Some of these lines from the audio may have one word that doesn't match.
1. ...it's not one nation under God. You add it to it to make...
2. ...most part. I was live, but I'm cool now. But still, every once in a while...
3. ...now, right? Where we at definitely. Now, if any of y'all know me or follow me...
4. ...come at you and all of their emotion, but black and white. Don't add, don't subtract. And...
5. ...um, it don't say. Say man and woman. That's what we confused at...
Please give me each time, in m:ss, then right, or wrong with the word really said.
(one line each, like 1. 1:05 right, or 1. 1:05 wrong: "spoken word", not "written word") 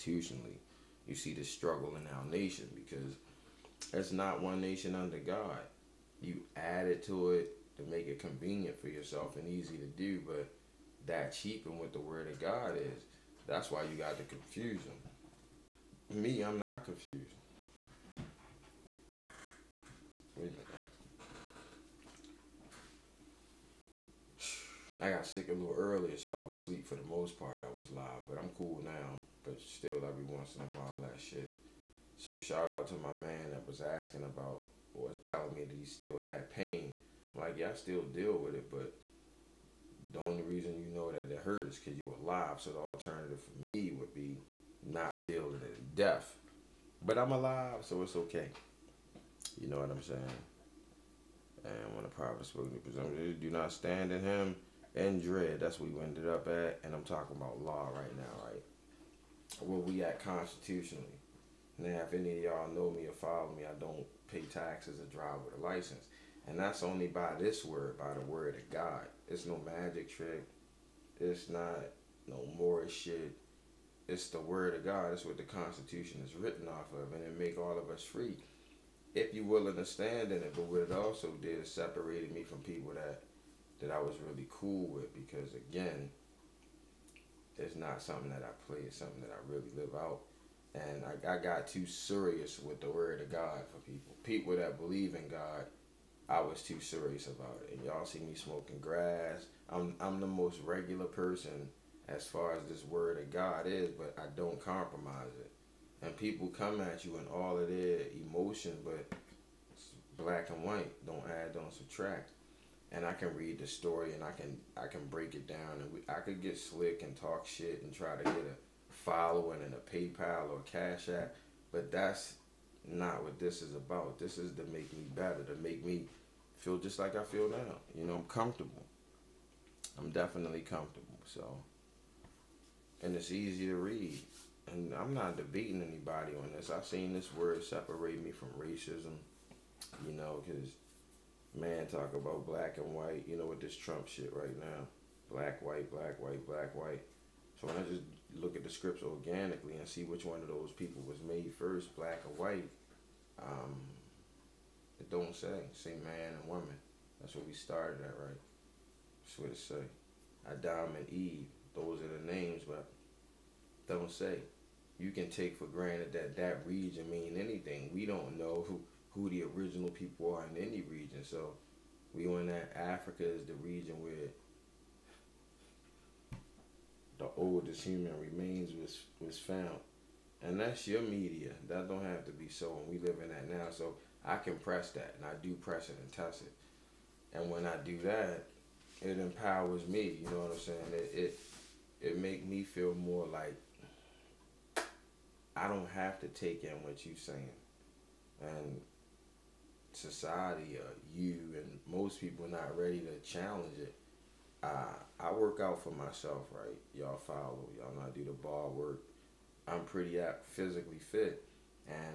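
1. 0:03 right
2. 0:27 right
3. 0:58 wrong: "constitutionally", not "definitely"
4. 1:46 right
5. 2:33 wrong: "started", not "confused".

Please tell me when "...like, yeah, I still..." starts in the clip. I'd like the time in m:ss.
0:37.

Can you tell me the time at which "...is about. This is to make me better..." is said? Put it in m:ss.
2:03.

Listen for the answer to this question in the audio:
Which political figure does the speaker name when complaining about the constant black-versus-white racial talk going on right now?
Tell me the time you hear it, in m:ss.
2:23.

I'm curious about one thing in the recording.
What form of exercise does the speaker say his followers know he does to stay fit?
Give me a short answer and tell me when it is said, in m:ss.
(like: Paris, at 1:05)
Bar work, at 3:28.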